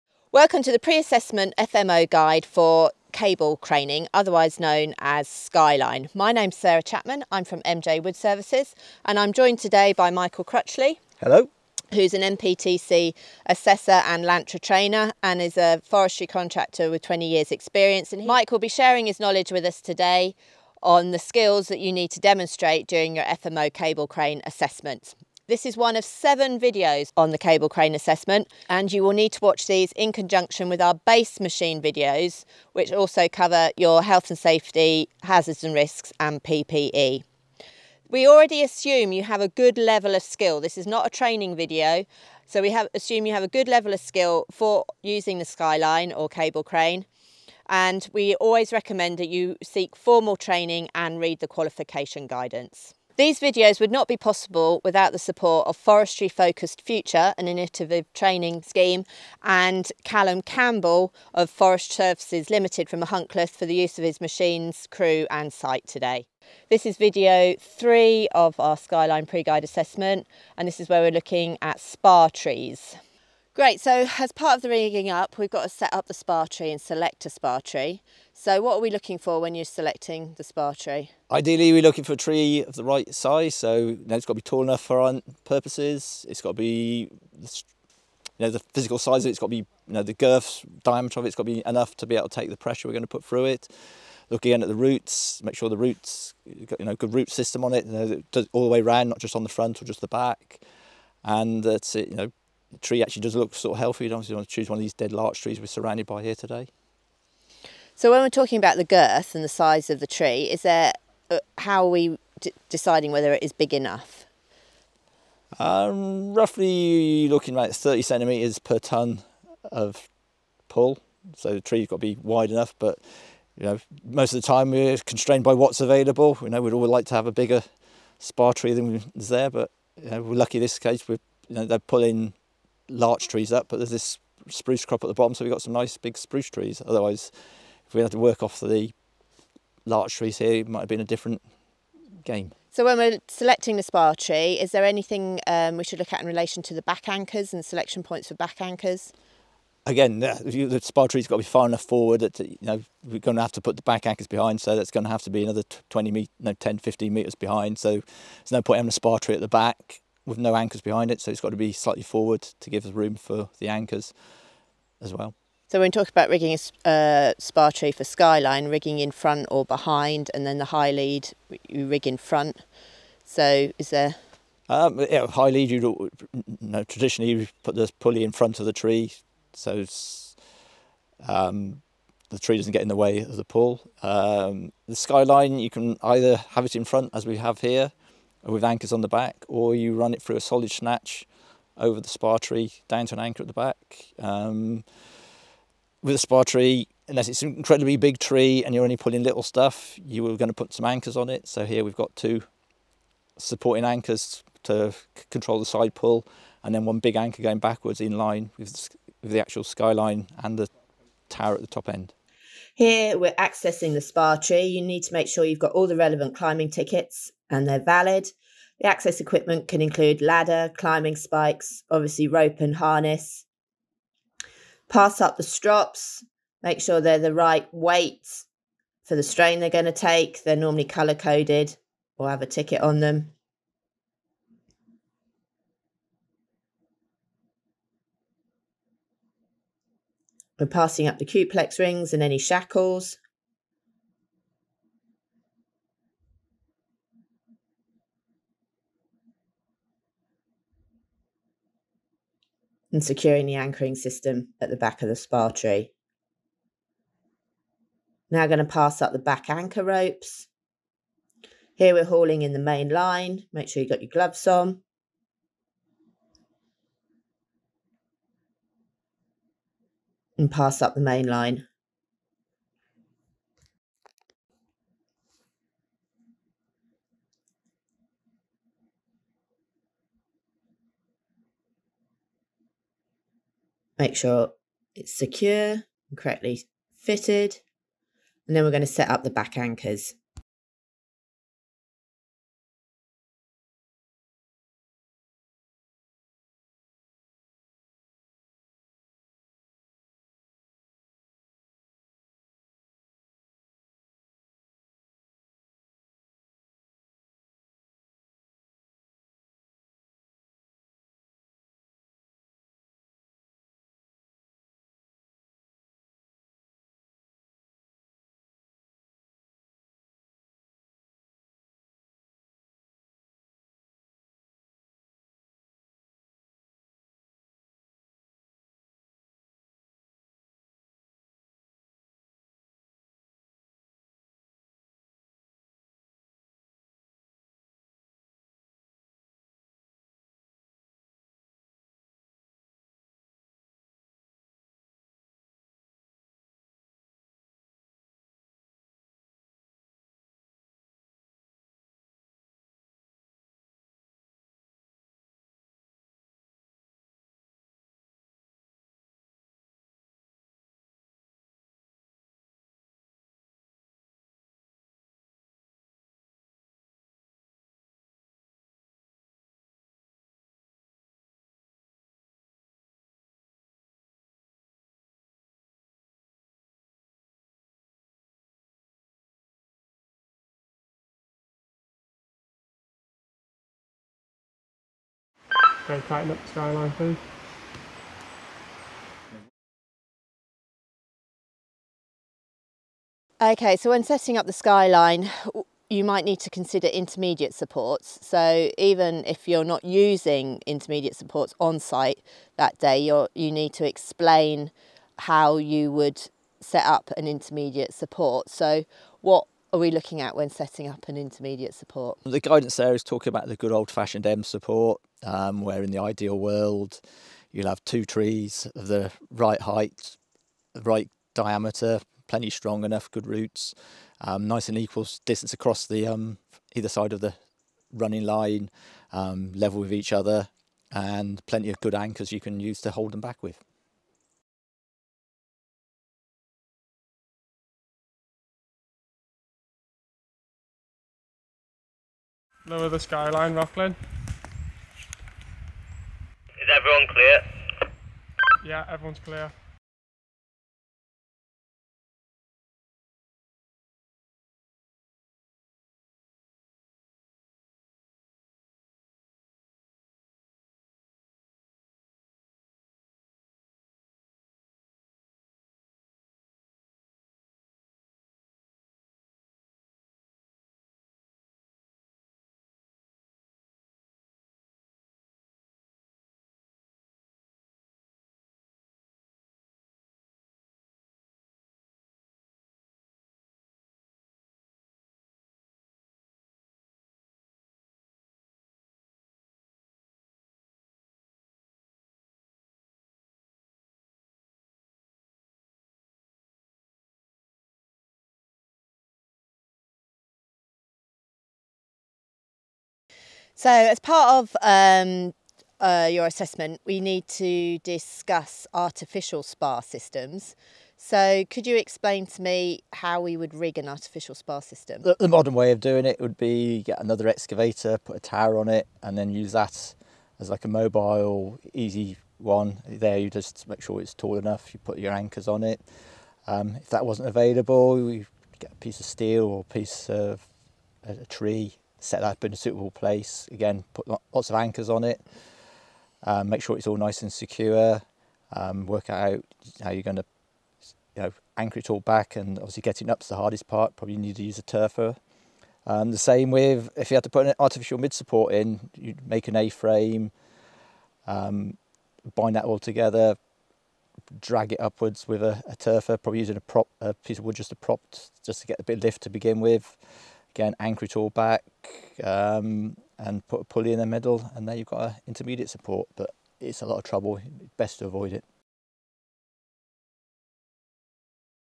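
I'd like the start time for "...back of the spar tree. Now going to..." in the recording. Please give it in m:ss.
4:14.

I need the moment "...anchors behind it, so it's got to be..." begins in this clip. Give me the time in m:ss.
2:40.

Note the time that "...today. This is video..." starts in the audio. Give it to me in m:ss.
1:05.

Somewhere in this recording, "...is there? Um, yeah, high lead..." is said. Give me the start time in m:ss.
2:53.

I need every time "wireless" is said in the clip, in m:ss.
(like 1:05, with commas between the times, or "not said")
not said.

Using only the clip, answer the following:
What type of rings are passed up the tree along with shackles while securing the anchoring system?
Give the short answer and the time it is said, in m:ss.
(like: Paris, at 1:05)
Cuplex rings, at 4:01.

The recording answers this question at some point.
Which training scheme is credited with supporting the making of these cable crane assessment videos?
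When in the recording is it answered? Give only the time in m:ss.
0:55.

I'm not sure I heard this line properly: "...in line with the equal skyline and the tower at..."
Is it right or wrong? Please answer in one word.
wrong.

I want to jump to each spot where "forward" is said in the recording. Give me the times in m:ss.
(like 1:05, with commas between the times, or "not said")
2:31, 2:42.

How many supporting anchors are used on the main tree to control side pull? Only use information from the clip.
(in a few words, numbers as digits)
2.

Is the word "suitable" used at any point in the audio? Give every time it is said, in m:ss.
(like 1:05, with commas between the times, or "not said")
8:52.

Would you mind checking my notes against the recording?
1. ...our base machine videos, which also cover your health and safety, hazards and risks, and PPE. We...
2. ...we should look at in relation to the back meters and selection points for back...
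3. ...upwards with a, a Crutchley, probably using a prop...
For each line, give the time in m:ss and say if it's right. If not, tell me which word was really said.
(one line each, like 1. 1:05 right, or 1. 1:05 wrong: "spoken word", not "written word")
1. 0:30 right
2. 2:25 wrong: "anchors", not "meters"
3. 9:14 wrong: "Tirfor", not "Crutchley".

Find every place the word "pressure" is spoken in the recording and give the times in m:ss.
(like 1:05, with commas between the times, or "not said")
1:32.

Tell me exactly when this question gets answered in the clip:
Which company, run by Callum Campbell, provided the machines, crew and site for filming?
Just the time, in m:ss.
1:01.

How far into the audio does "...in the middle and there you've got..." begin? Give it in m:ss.
9:23.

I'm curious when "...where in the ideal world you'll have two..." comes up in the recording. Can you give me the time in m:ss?
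6:55.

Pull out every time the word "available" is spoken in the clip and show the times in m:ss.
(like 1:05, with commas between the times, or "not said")
2:05, 8:47.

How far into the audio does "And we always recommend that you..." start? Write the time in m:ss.
0:47.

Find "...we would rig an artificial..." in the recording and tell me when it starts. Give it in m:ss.
8:33.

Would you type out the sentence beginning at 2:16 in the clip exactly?
Otherwise, if we had to work off the larch trees here, it might have been a different game.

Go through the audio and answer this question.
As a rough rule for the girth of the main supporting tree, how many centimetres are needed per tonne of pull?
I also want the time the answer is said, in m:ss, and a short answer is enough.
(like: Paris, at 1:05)
30, at 1:57.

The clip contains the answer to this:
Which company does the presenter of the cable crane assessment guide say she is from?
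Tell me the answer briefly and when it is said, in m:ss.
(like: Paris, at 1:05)
MJ Wood Services, at 0:07.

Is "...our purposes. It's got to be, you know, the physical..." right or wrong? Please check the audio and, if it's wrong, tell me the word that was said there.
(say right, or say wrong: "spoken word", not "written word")
right.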